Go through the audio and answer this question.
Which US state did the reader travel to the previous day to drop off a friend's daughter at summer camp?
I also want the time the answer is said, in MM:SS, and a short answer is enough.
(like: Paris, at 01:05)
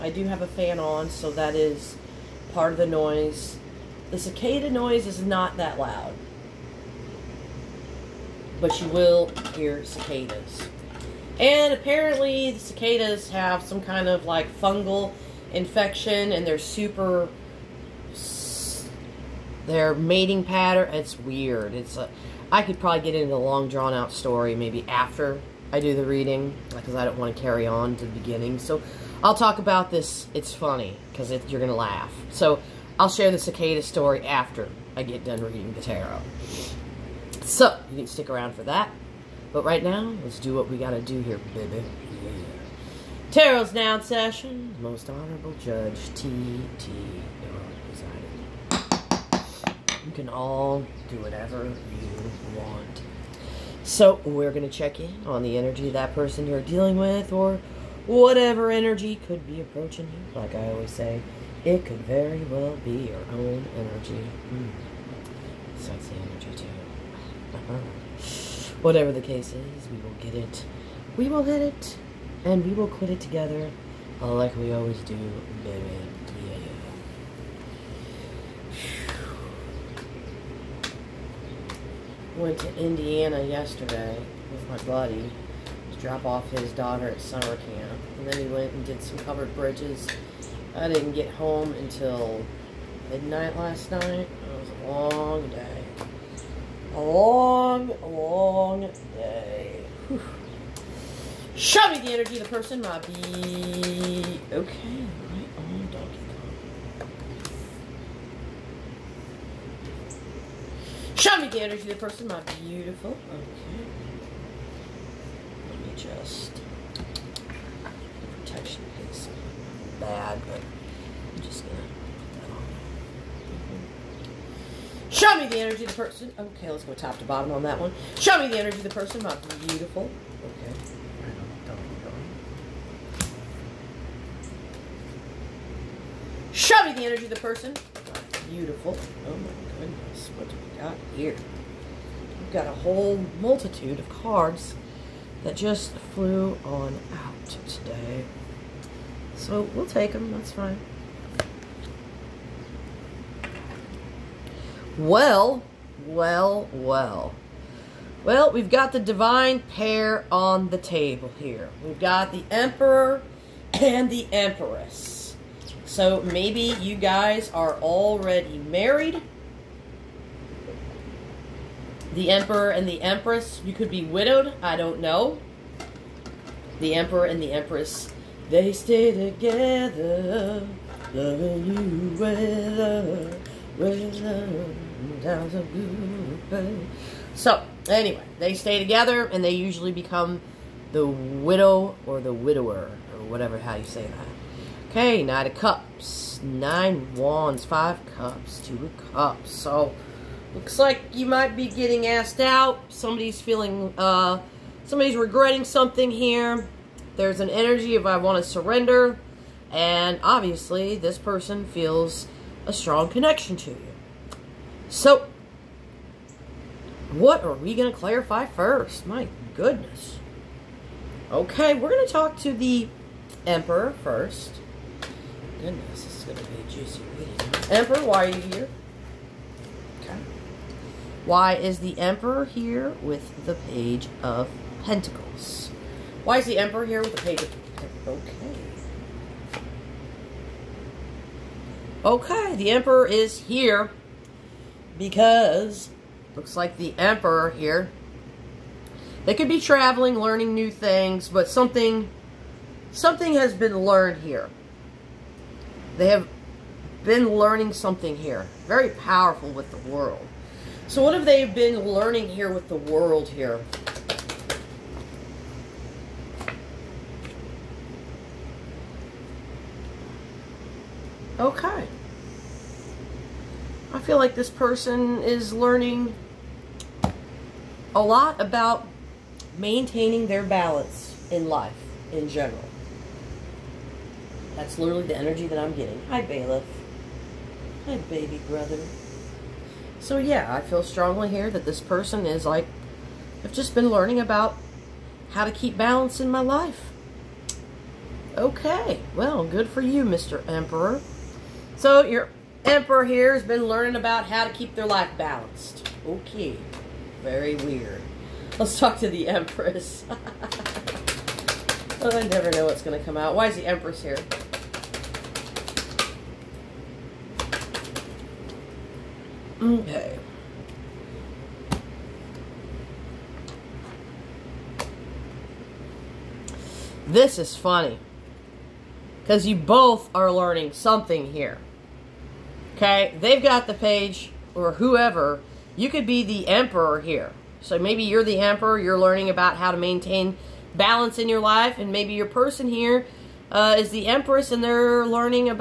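Indiana, at 01:22.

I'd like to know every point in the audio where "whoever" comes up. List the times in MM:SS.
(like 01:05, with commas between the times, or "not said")
05:34.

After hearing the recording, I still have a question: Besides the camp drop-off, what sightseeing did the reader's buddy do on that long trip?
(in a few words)
Covered bridges.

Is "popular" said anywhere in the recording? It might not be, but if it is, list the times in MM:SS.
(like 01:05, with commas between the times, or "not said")
not said.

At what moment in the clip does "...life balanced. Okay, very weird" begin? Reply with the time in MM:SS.
05:04.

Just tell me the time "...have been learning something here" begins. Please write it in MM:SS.
04:16.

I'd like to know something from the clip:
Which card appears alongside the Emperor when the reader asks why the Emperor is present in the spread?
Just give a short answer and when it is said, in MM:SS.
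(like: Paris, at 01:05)
Page of Pentacles, at 03:53.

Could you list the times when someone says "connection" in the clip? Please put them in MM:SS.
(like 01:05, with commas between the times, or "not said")
03:33.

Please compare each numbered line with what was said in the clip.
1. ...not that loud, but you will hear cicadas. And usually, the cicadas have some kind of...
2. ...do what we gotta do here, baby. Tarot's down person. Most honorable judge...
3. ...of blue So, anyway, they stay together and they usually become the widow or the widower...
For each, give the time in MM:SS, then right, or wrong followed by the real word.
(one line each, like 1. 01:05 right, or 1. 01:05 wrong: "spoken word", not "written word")
1. 00:05 wrong: "apparently", not "usually"
2. 00:40 wrong: "session", not "person"
3. 03:05 right.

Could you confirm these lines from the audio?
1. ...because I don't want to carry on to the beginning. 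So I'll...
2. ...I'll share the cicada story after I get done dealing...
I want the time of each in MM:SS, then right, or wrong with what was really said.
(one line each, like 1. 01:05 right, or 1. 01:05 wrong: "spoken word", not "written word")
1. 00:26 right
2. 00:32 wrong: "reading", not "dealing".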